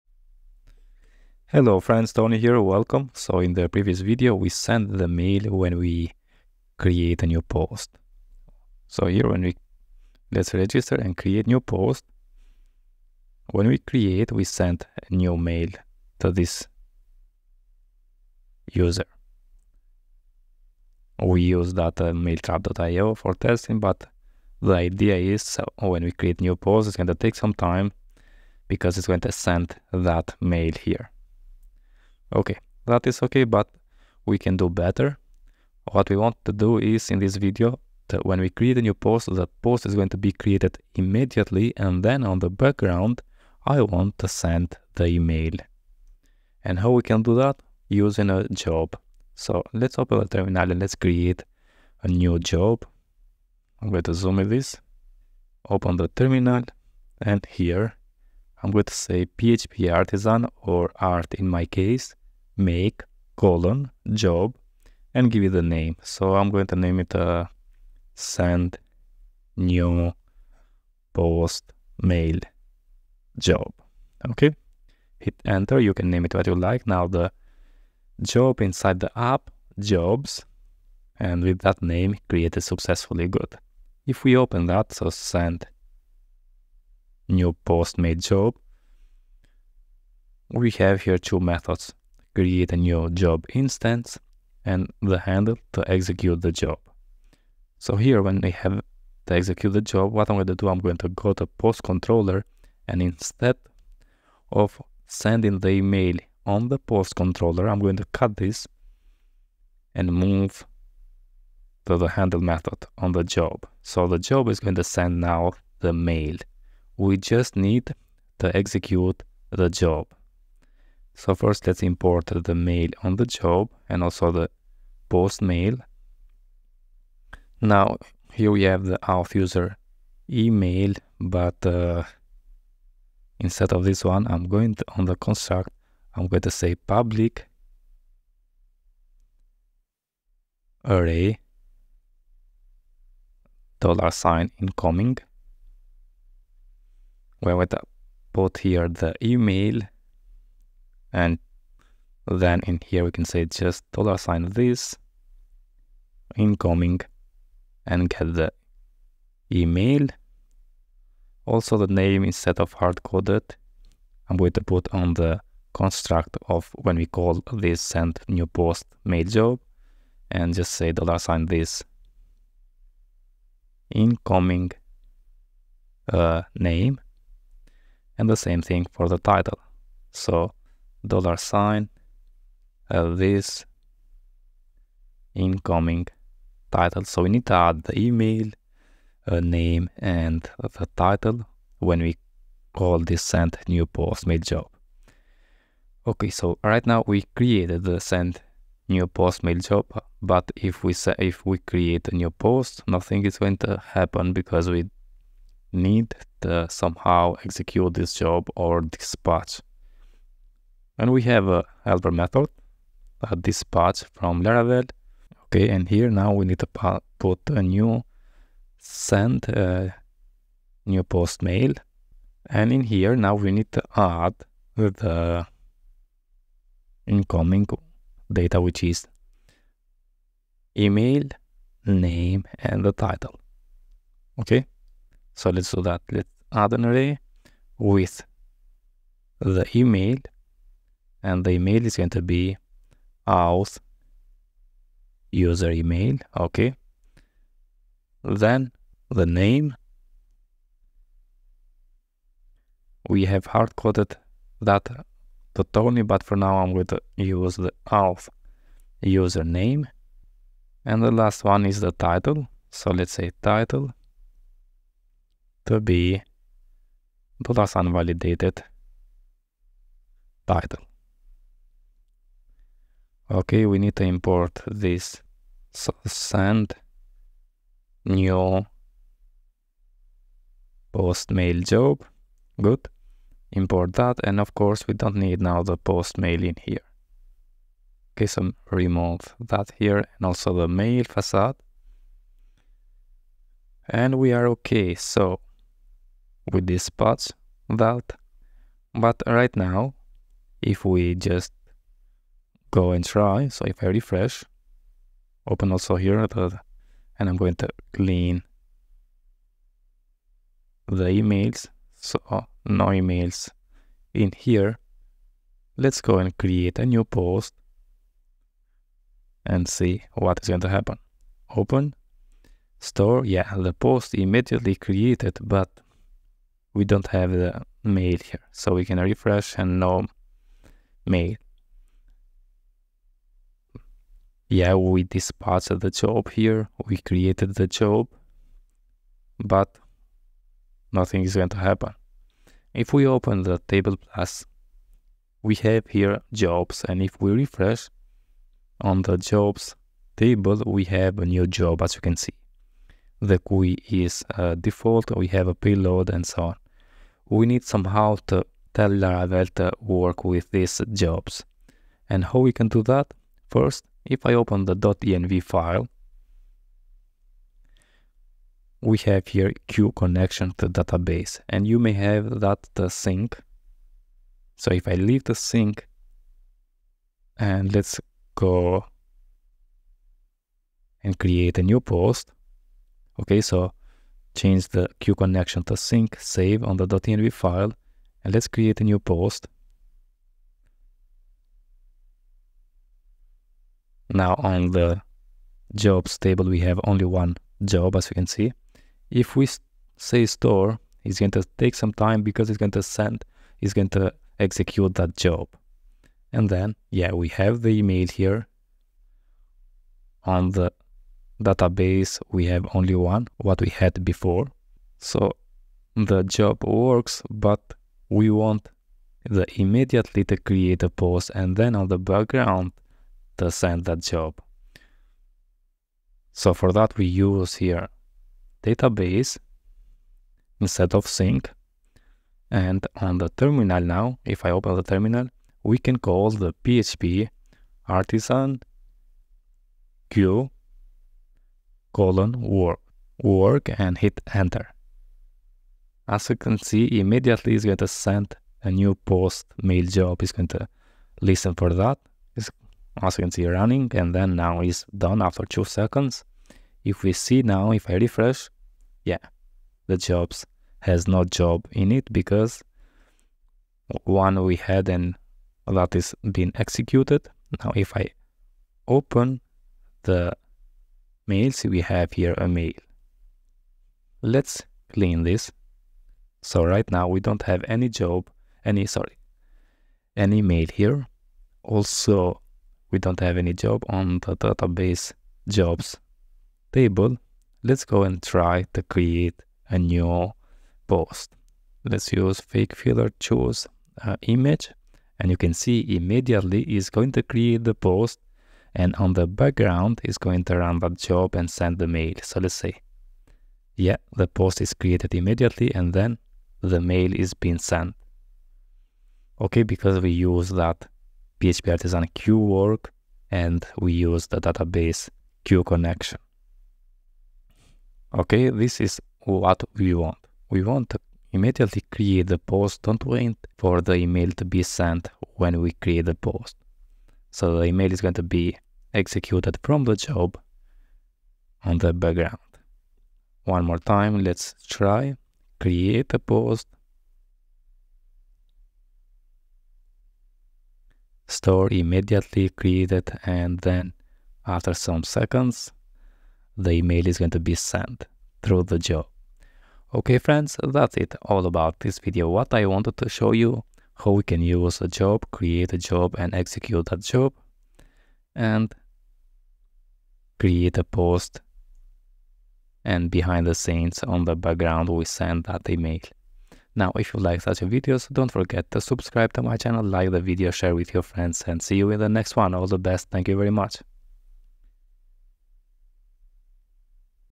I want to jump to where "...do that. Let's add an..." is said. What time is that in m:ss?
3:55.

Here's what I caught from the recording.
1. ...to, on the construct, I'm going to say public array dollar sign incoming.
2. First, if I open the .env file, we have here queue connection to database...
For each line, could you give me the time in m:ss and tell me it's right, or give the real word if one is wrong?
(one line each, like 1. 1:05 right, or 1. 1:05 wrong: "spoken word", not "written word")
1. 2:14 right
2. 6:03 right.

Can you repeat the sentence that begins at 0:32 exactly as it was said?
Okay, that is okay, but we can do better.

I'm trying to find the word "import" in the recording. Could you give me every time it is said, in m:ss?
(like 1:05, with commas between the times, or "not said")
2:01, 4:34, 4:43.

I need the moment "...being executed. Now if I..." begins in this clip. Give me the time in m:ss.
7:46.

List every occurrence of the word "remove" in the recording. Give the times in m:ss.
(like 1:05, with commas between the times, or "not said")
4:48.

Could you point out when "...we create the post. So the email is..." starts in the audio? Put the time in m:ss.
8:45.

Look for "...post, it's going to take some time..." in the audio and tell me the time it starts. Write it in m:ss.
0:26.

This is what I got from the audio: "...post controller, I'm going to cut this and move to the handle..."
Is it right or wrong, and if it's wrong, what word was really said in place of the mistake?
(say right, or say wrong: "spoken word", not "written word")
right.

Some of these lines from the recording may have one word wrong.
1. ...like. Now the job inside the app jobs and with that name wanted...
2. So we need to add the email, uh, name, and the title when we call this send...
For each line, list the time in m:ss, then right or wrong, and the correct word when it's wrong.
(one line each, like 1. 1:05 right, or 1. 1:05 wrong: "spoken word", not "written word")
1. 1:16 wrong: "created", not "wanted"
2. 3:07 right.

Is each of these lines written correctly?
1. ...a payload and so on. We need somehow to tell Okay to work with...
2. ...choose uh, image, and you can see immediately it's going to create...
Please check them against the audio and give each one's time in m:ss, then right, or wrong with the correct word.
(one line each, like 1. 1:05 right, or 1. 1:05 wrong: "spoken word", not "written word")
1. 5:55 wrong: "Laravel", not "Okay"
2. 8:13 right.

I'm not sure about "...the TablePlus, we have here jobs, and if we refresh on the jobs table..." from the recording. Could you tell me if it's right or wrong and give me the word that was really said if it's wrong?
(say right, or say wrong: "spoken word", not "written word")
right.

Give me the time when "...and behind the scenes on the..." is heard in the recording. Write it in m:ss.
9:22.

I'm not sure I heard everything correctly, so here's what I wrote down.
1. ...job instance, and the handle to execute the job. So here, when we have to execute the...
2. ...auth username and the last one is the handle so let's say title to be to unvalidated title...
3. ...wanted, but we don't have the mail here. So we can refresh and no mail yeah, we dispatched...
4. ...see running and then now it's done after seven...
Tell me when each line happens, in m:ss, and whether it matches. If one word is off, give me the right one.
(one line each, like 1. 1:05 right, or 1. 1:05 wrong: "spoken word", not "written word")
1. 1:33 right
2. 4:17 wrong: "title", not "handle"
3. 5:24 wrong: "created", not "wanted"
4. 7:33 wrong: "two", not "seven".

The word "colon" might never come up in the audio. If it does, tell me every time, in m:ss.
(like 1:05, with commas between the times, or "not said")
1:03, 7:21.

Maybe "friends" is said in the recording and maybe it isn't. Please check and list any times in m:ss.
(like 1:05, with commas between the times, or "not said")
0:01, 9:10, 9:31.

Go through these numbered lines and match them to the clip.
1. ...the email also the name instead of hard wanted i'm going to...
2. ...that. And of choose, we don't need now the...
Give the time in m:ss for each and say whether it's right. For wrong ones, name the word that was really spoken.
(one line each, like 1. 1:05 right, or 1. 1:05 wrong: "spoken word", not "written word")
1. 2:38 wrong: "coded", not "wanted"
2. 4:43 wrong: "course", not "choose".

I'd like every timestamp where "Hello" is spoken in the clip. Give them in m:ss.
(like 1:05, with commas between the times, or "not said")
0:01.